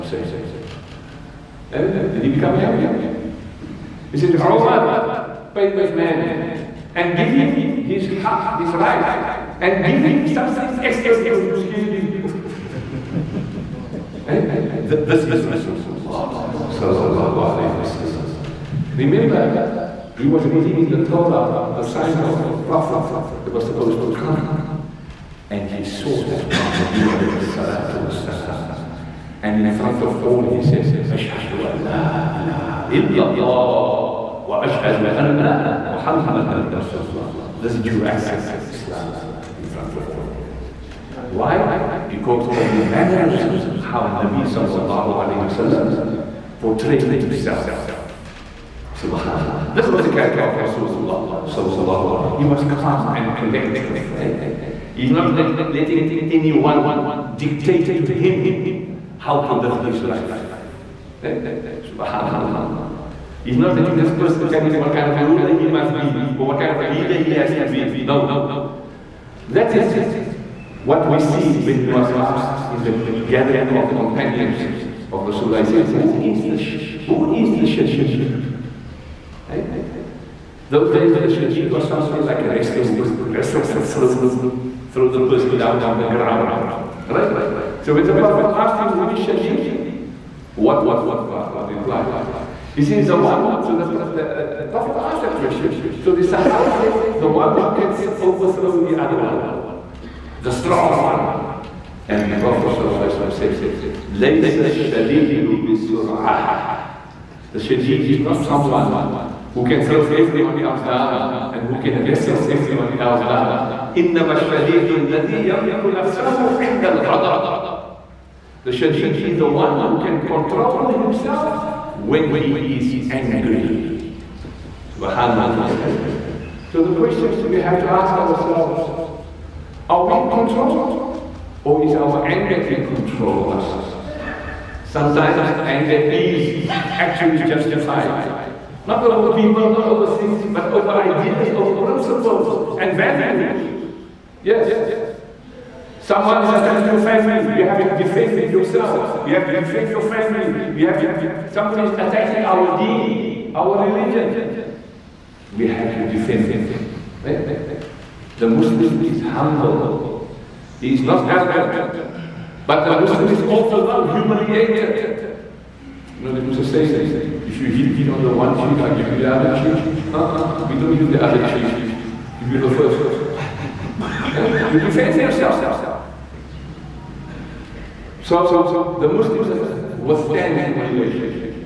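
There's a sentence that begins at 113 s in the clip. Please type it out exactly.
إنما الشديد الذي يملك نفسه عند الغضب.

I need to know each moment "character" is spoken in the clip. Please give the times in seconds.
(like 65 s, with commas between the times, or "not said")
50 s.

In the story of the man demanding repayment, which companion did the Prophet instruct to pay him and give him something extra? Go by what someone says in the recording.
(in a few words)
Omar.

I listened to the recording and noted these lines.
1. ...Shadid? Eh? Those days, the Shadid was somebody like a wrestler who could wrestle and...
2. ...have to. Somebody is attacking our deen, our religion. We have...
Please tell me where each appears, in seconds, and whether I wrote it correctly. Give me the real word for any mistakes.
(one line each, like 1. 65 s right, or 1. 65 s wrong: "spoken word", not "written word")
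1. 77 s right
2. 150 s right.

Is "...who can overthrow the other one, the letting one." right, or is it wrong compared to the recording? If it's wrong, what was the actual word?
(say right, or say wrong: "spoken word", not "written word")
wrong: "strong", not "letting".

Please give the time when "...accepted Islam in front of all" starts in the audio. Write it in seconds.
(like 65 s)
38 s.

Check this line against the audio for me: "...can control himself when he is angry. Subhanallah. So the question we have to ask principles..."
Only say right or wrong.
wrong.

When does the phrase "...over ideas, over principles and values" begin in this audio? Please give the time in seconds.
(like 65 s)
140 s.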